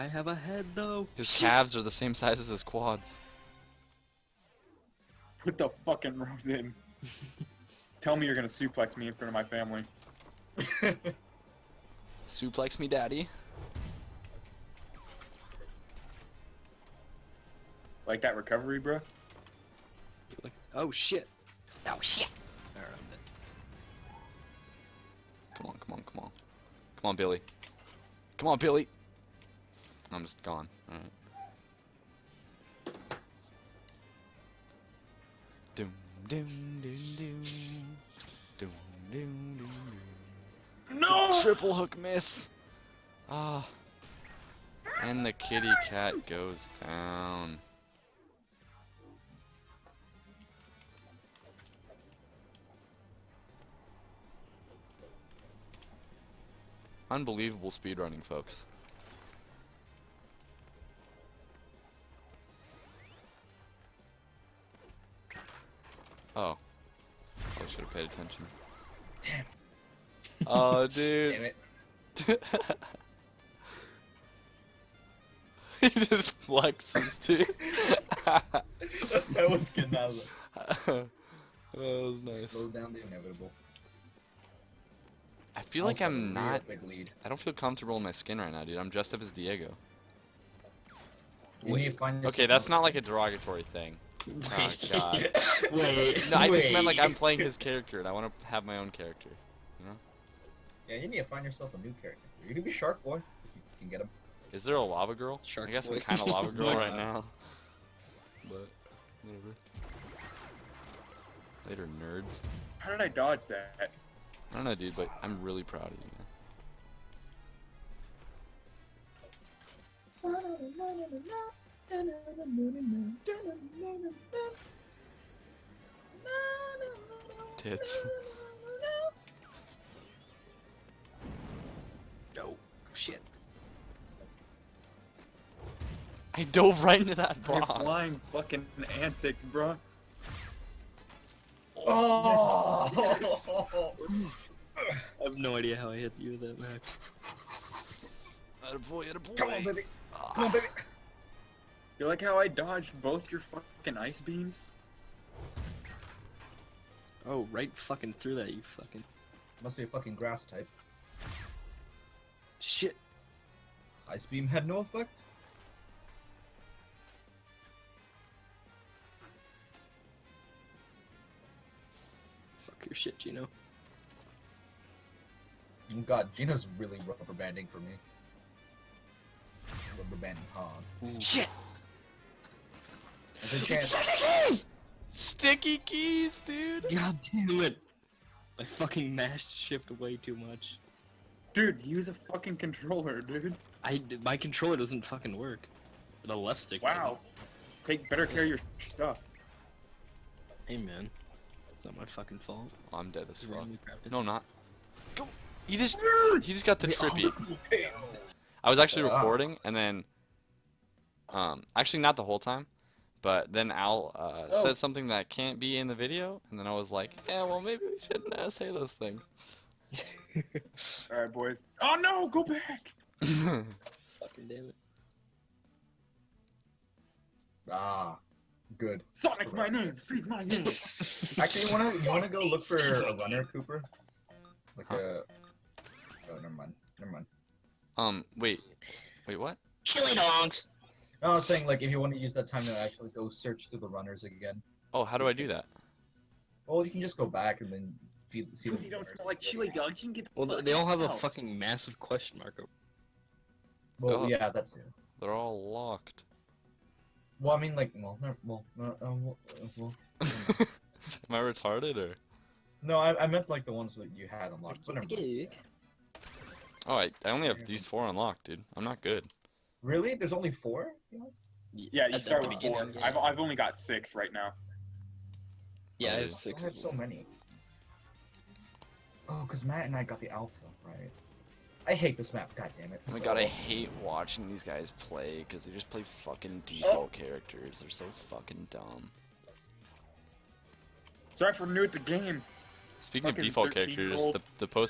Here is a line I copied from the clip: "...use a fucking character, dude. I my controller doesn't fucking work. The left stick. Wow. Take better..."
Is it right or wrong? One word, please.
wrong.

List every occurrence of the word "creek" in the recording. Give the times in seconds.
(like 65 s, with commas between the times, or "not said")
not said.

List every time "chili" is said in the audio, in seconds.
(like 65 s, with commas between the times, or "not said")
239 s, 249 s.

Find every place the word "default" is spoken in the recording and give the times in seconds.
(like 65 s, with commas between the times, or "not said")
286 s, 293 s.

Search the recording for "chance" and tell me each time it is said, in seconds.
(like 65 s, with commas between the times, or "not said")
183 s.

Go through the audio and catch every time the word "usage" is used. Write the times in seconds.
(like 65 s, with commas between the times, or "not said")
not said.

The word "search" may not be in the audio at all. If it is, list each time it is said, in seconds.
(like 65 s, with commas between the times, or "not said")
243 s.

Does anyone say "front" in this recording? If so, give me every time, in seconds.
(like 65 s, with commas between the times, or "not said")
9 s.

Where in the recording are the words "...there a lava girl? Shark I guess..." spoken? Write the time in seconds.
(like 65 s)
104 s.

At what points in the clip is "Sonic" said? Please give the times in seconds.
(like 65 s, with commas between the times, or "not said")
229 s.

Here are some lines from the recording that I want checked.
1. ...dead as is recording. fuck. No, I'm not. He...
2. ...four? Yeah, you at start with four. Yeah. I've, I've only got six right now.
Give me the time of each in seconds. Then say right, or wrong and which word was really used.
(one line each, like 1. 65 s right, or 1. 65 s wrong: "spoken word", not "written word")
1. 203 s wrong: "wrong", not "recording"
2. 270 s right.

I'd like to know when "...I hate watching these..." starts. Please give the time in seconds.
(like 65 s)
283 s.